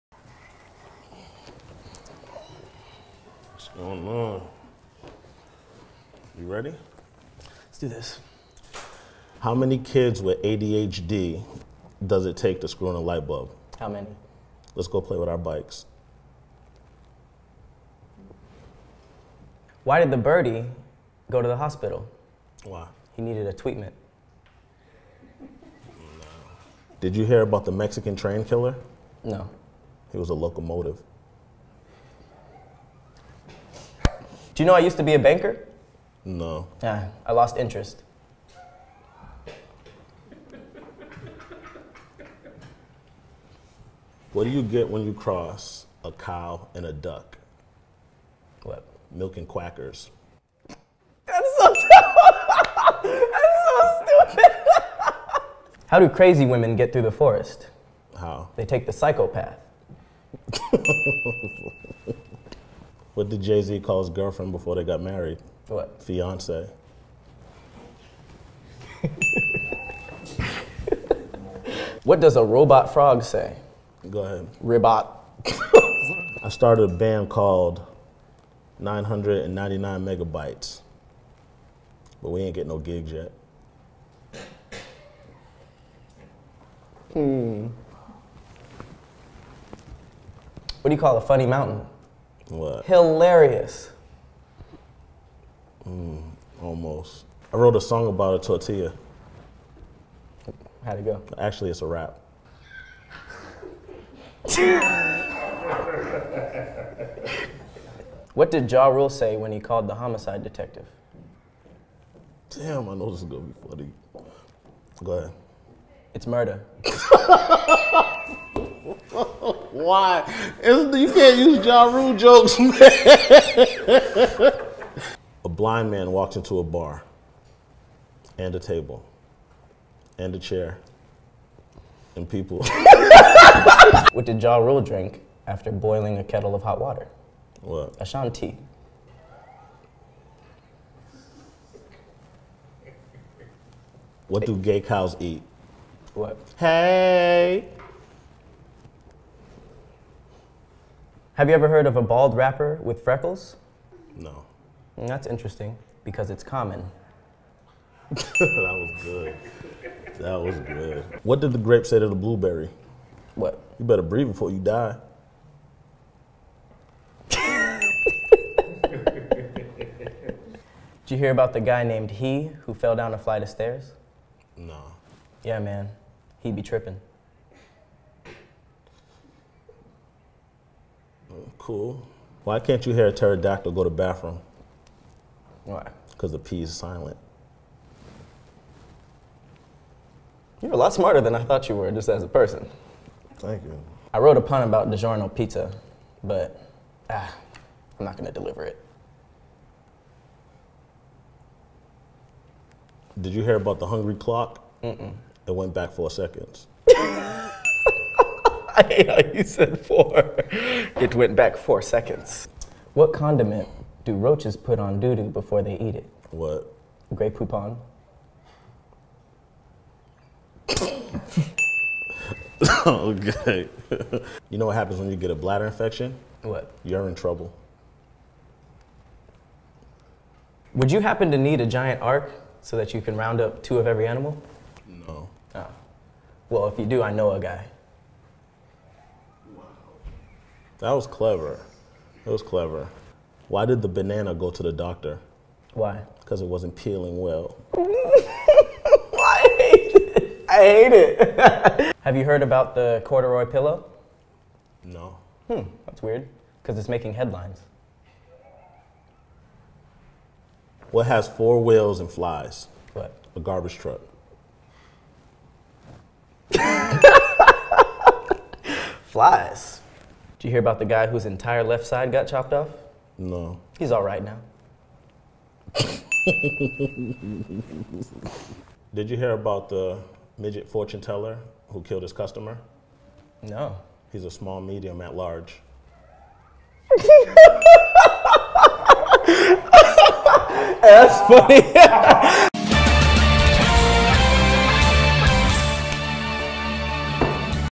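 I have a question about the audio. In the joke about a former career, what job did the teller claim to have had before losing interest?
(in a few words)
Banker.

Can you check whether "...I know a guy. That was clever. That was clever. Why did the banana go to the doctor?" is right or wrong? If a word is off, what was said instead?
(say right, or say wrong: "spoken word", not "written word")
right.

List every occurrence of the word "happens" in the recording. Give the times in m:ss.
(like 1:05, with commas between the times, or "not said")
3:44, 3:51.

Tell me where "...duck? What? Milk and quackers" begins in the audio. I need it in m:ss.
0:46.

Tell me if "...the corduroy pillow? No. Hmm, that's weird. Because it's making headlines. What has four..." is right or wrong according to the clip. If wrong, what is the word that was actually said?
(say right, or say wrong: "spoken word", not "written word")
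right.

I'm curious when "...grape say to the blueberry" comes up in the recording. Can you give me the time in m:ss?
2:41.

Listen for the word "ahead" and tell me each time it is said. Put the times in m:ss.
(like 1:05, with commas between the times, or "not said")
1:14, 1:55.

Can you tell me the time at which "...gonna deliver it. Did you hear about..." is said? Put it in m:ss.
3:18.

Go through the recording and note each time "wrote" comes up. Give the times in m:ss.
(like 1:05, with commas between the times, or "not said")
1:37, 3:14.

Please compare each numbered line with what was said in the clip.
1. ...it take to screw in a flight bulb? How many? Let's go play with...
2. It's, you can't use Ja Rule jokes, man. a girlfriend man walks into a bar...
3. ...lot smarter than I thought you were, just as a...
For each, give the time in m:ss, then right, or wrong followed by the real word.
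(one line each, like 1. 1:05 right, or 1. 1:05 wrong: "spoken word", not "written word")
1. 0:12 wrong: "light", not "flight"
2. 2:00 wrong: "blind", not "girlfriend"
3. 3:10 right.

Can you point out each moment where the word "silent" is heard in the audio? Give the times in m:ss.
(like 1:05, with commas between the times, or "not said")
3:06.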